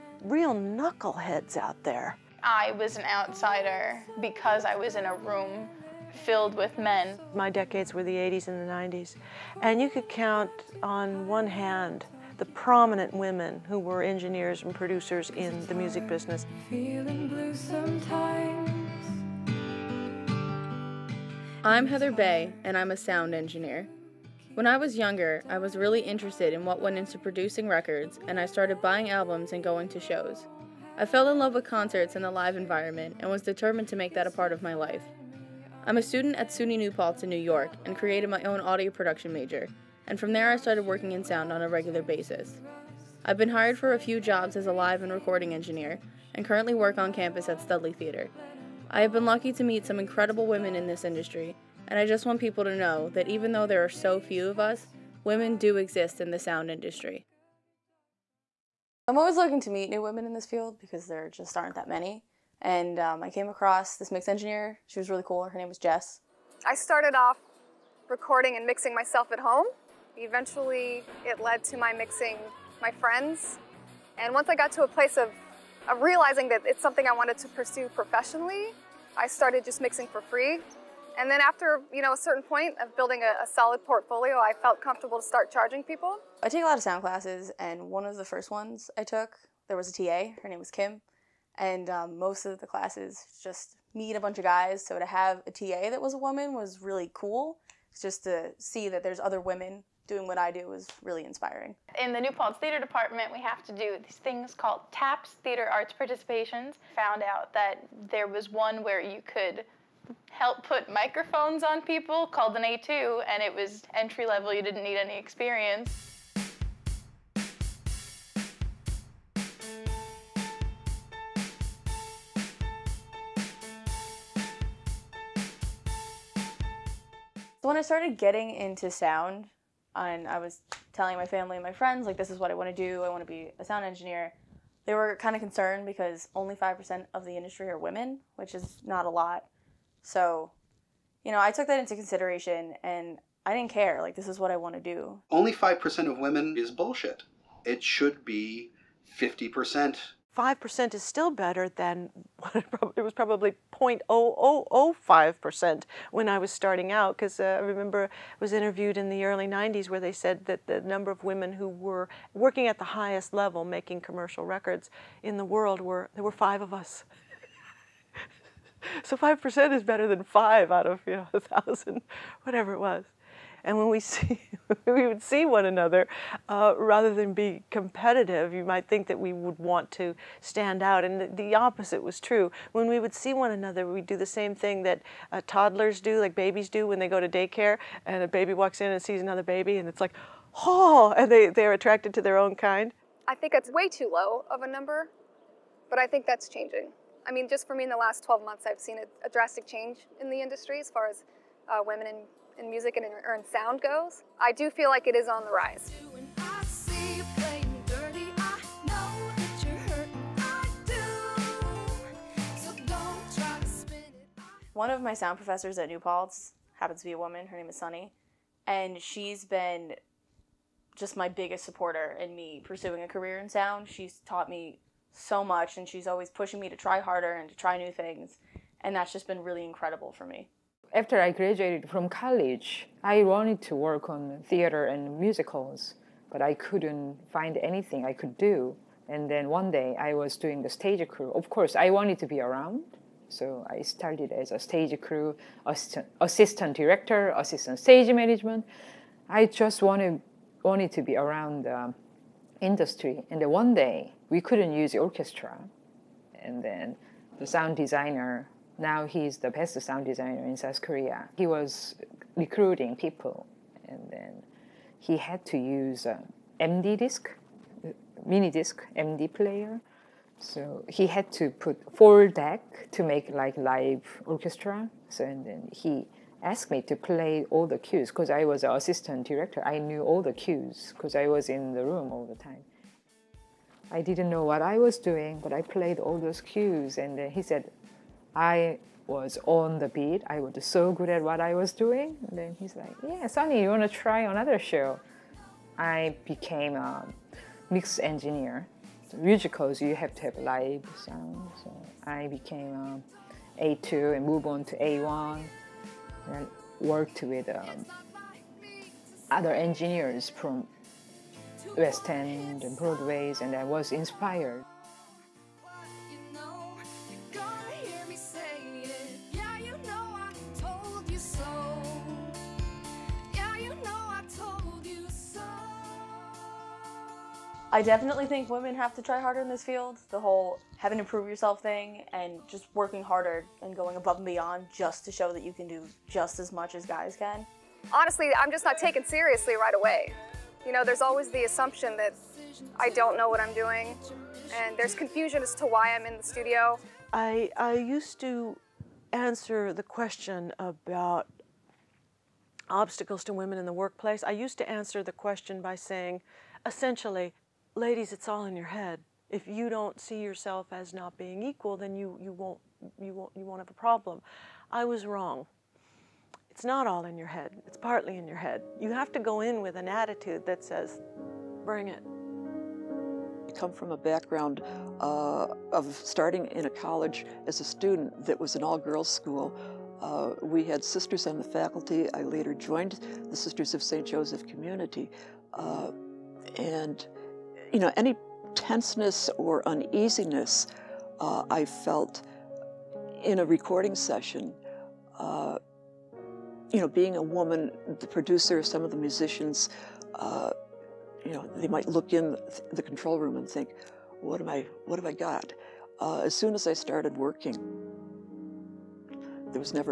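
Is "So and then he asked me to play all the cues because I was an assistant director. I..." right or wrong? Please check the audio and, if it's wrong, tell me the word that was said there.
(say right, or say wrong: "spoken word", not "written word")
right.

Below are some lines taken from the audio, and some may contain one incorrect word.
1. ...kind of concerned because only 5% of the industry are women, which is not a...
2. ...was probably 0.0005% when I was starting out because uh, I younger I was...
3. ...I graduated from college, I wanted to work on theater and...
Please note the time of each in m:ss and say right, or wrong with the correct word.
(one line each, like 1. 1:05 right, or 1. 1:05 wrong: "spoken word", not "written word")
1. 2:15 right
2. 2:33 wrong: "remember", not "younger"
3. 3:51 right.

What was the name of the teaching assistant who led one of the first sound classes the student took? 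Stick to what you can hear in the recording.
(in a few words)
Kim.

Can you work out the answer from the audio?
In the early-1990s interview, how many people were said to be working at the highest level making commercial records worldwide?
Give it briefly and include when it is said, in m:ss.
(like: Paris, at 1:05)
5, at 2:46.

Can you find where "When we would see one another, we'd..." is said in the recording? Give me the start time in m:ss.
3:02.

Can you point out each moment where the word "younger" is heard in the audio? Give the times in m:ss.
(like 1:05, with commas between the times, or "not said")
0:24.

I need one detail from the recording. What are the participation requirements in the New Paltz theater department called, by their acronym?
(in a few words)
TAPS.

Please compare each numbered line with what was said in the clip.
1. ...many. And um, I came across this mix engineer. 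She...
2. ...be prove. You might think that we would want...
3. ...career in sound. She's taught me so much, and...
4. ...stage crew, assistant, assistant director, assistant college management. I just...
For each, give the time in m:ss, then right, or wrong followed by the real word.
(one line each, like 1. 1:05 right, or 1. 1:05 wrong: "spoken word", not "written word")
1. 1:01 right
2. 2:57 wrong: "competitive", not "prove"
3. 3:43 right
4. 4:04 wrong: "stage", not "college".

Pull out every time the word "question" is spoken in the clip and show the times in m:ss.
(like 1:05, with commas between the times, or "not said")
5:49, 5:55.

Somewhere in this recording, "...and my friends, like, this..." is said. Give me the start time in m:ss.
2:11.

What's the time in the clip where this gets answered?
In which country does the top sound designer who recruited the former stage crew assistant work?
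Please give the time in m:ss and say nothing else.
4:20.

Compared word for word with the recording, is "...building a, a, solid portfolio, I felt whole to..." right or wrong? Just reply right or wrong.
wrong.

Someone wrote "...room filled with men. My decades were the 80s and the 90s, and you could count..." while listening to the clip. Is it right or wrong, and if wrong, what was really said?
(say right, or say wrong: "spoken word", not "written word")
right.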